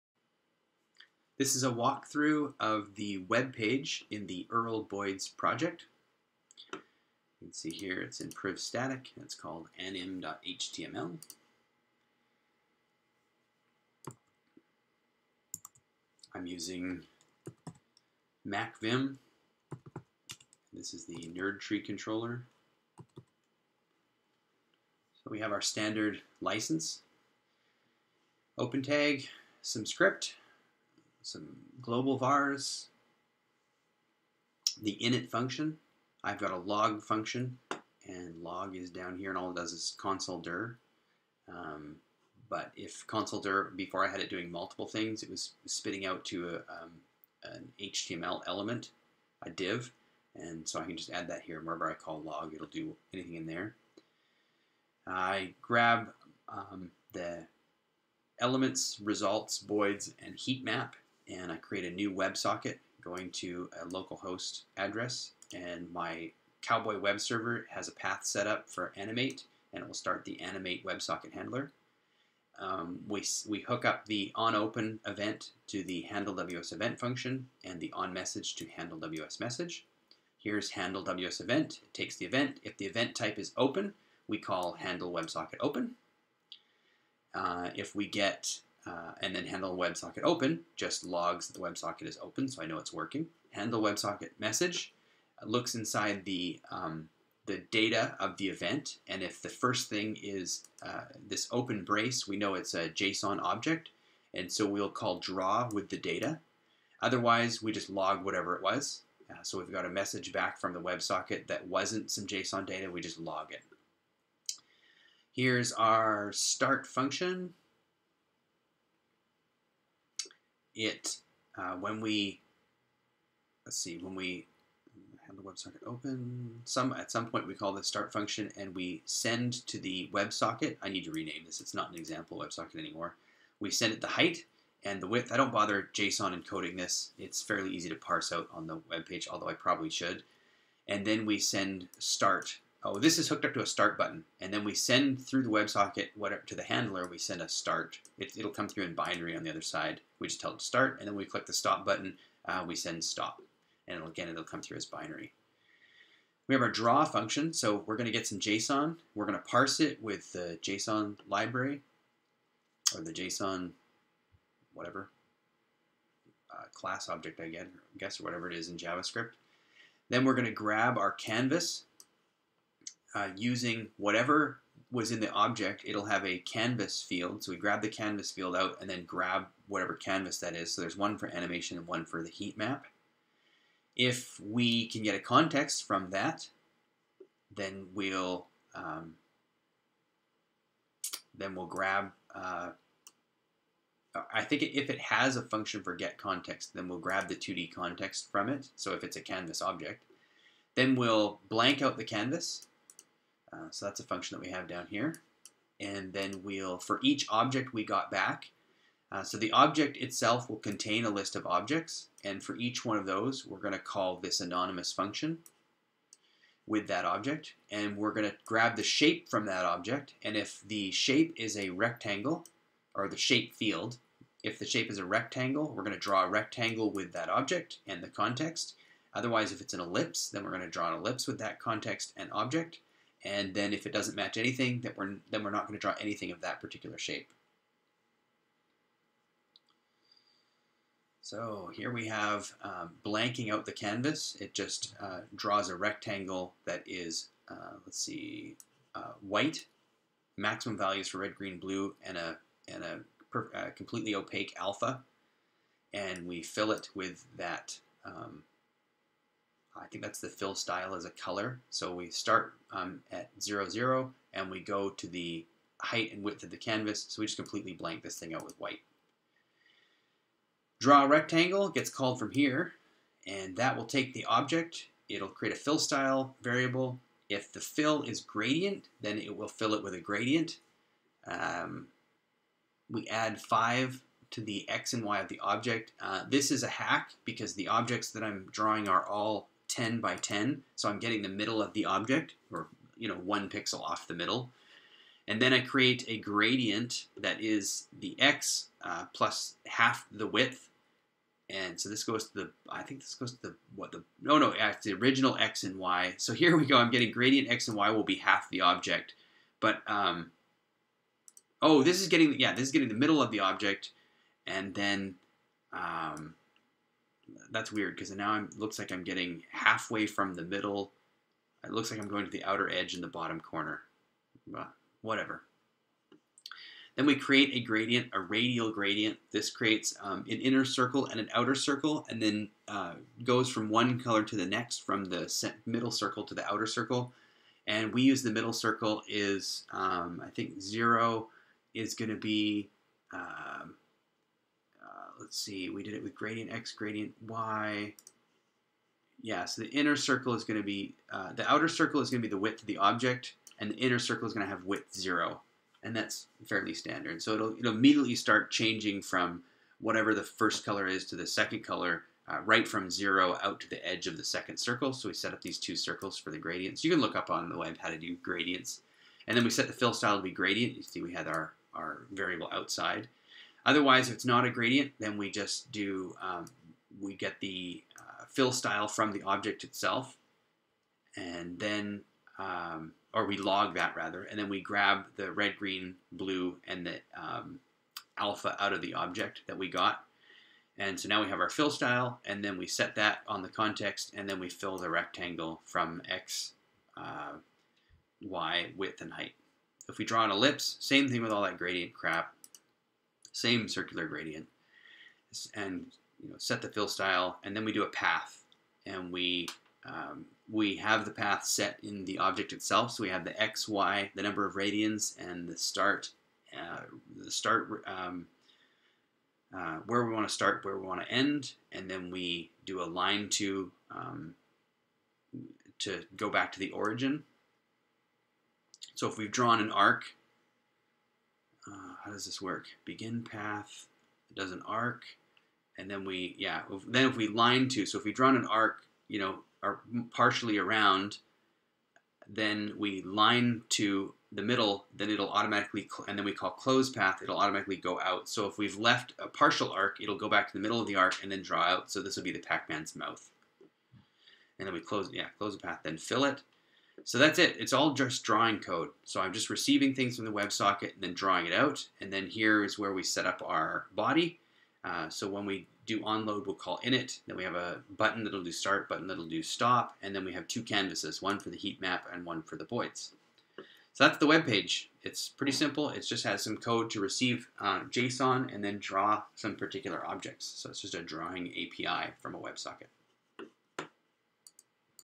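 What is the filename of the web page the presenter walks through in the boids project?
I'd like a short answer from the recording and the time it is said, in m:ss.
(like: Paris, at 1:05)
anim.html, at 0:09.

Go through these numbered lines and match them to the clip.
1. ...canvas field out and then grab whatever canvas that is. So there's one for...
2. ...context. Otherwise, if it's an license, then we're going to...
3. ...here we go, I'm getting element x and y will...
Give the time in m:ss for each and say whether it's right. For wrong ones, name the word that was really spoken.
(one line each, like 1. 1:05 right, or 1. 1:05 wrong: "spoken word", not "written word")
1. 2:57 right
2. 3:48 wrong: "ellipse", not "license"
3. 5:06 wrong: "gradient", not "element".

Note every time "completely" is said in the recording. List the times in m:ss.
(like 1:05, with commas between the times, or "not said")
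4:13, 4:27.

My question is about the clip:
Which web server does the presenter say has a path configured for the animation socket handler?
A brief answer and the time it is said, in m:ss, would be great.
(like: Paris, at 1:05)
Cowboy, at 1:06.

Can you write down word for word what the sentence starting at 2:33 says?
And it'll, again, it'll come through as binary.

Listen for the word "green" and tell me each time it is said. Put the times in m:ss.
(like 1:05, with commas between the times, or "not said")
4:11, 6:25.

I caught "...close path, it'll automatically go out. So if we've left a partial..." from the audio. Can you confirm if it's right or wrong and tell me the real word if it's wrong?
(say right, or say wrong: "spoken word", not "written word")
right.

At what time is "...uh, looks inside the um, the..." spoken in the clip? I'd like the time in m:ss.
1:35.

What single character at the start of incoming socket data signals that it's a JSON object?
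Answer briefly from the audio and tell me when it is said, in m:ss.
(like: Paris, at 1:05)
open brace, at 1:41.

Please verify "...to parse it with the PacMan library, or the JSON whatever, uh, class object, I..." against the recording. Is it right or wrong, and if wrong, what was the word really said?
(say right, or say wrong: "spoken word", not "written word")
wrong: "JSON", not "PacMan".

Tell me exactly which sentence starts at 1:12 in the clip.
Um, we, we hook up the onOpen event to the handleWS event function and the onMessage to handleWS message.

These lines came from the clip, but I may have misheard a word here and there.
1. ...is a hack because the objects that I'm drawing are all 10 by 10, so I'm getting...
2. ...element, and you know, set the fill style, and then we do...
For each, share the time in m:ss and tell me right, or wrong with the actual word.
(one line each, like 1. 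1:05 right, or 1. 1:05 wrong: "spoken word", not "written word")
1. 4:46 right
2. 6:44 wrong: "gradient", not "element".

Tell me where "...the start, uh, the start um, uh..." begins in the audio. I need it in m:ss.
6:55.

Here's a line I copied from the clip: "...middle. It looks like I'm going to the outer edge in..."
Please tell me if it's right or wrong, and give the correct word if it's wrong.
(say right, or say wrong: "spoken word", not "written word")
right.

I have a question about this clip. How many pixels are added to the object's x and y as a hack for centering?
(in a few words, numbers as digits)
5.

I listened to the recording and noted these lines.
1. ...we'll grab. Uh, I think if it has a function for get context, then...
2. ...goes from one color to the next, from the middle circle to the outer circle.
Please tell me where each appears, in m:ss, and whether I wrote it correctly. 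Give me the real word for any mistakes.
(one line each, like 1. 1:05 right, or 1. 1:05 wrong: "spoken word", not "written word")
1. 3:11 right
2. 5:33 right.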